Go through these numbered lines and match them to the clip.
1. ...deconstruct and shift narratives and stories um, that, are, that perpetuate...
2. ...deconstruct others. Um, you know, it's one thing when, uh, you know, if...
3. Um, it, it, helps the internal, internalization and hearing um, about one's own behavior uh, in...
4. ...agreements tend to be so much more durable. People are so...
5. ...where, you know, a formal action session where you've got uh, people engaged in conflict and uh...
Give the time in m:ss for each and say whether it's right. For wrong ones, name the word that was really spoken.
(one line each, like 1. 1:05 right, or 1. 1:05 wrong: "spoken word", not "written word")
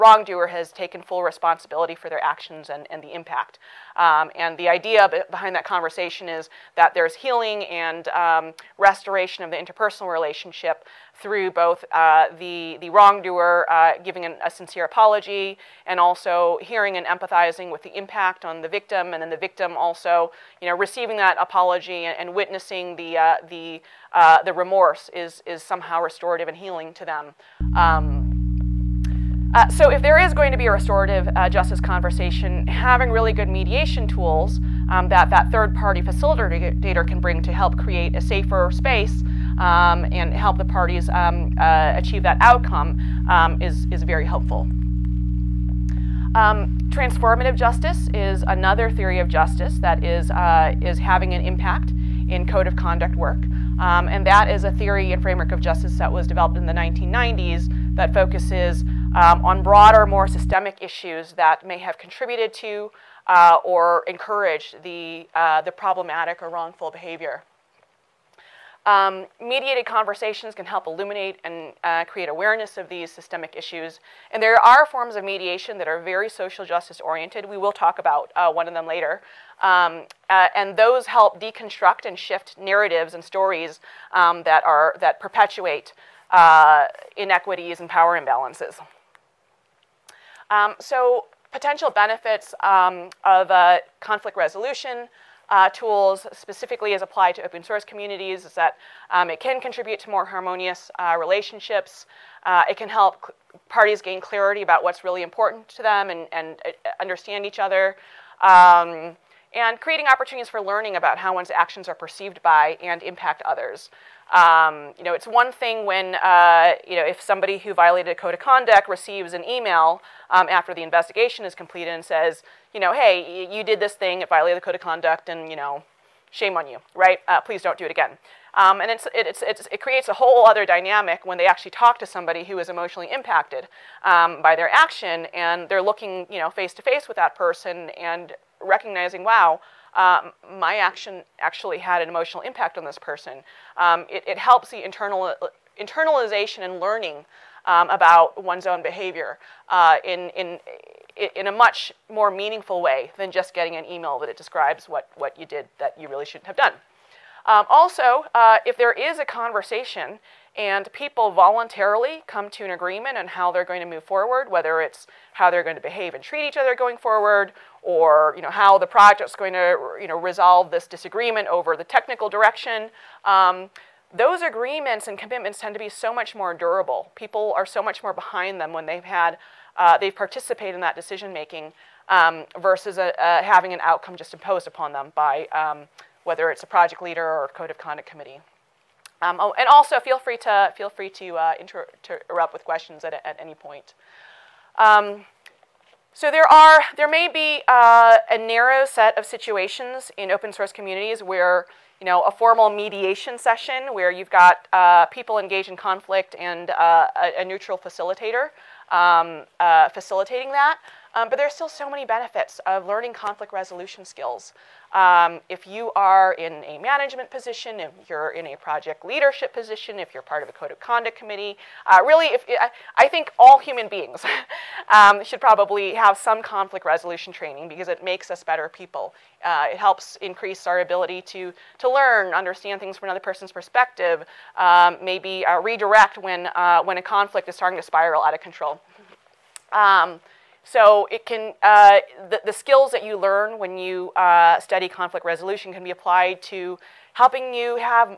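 1. 1:21 right
2. 1:53 wrong: "impact", not "deconstruct"
3. 2:23 wrong: "learning", not "hearing"
4. 2:55 wrong: "commitments", not "agreements"
5. 3:21 wrong: "mediation", not "action".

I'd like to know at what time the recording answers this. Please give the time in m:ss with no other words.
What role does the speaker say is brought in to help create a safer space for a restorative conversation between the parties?
0:35.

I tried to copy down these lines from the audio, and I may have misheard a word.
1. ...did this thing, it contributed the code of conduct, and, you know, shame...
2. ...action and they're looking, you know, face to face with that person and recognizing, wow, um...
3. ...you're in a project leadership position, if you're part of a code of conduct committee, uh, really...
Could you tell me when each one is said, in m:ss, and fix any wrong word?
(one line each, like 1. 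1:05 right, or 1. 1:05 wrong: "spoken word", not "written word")
1. 2:03 wrong: "violated", not "contributed"
2. 2:14 right
3. 3:38 right.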